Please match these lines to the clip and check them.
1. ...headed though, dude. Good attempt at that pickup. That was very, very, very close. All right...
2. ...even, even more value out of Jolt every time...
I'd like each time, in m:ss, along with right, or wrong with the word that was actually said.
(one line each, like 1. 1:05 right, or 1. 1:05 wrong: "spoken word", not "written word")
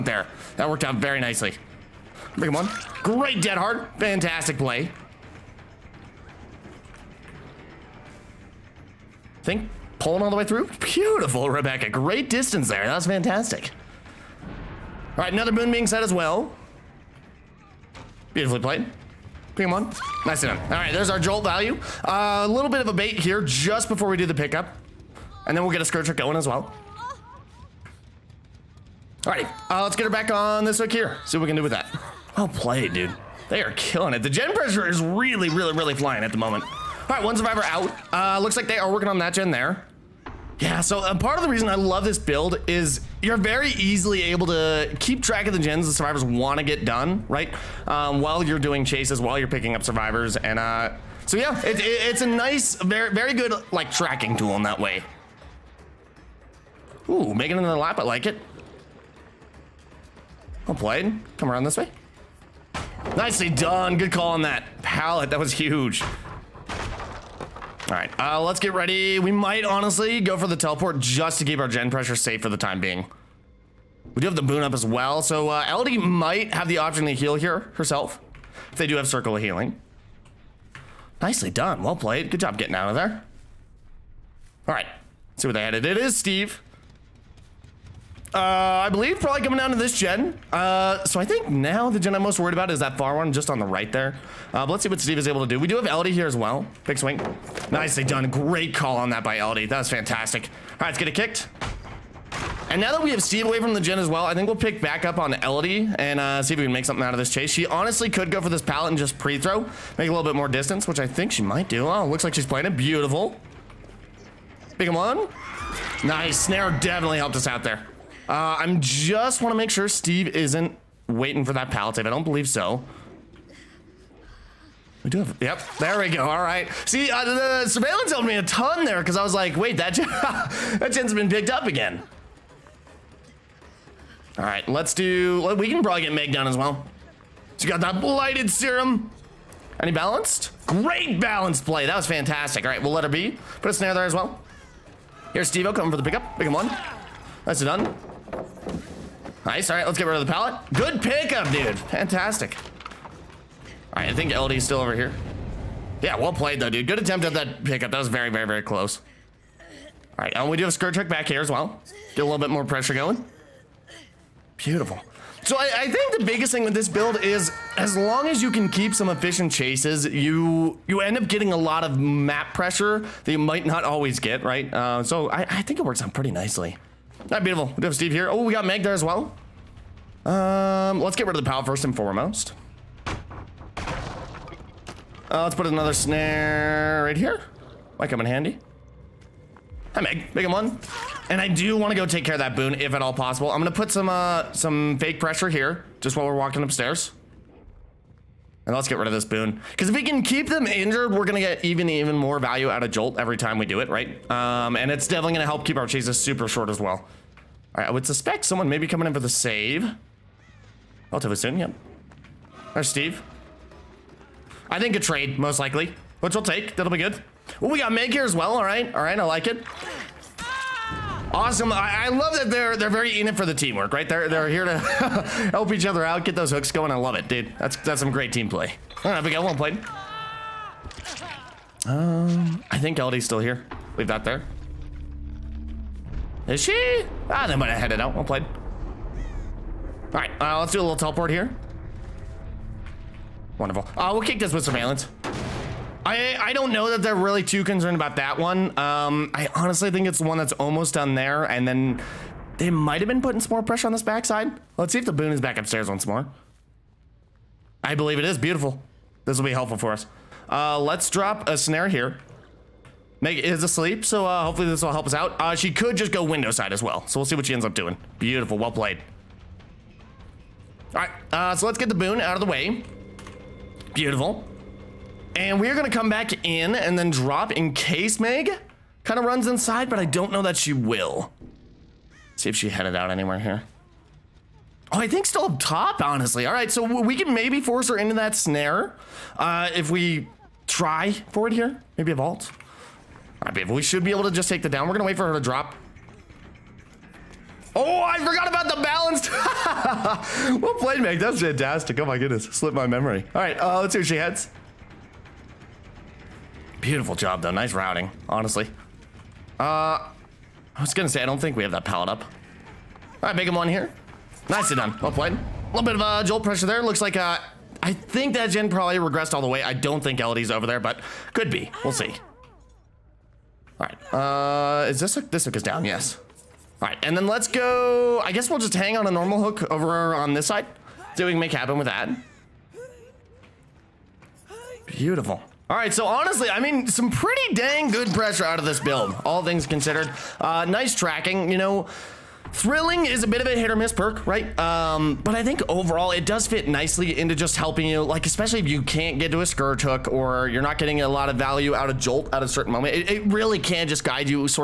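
1. 2:36 wrong: "played", not "headed"
2. 3:21 right.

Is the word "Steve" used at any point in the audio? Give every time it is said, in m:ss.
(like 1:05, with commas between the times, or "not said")
1:26, 1:34, 1:43, 1:59, 2:25, 2:57, 3:32.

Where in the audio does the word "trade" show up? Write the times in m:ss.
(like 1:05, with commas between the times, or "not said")
3:34.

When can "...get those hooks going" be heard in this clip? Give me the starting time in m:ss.
3:46.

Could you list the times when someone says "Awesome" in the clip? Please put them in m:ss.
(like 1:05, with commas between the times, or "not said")
3:41.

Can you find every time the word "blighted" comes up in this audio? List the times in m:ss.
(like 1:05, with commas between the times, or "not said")
2:17.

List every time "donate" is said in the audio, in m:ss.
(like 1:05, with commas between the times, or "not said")
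not said.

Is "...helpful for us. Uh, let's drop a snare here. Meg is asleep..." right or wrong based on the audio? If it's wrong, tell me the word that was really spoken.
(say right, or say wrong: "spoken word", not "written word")
right.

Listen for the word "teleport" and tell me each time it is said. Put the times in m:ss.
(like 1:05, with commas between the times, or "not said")
1:10, 4:00.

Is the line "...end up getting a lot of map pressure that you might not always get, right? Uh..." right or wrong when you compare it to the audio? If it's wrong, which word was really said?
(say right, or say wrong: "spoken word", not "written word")
right.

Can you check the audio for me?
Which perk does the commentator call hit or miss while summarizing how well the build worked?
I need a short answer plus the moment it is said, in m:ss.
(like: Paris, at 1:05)
Thrilling, at 5:42.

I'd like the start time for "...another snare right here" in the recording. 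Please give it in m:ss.
3:05.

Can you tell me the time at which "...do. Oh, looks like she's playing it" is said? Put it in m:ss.
1:51.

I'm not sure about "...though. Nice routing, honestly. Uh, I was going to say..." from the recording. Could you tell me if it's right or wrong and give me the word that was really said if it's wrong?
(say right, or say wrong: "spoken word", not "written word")
right.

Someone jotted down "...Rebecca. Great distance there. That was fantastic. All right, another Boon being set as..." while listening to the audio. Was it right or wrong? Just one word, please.
right.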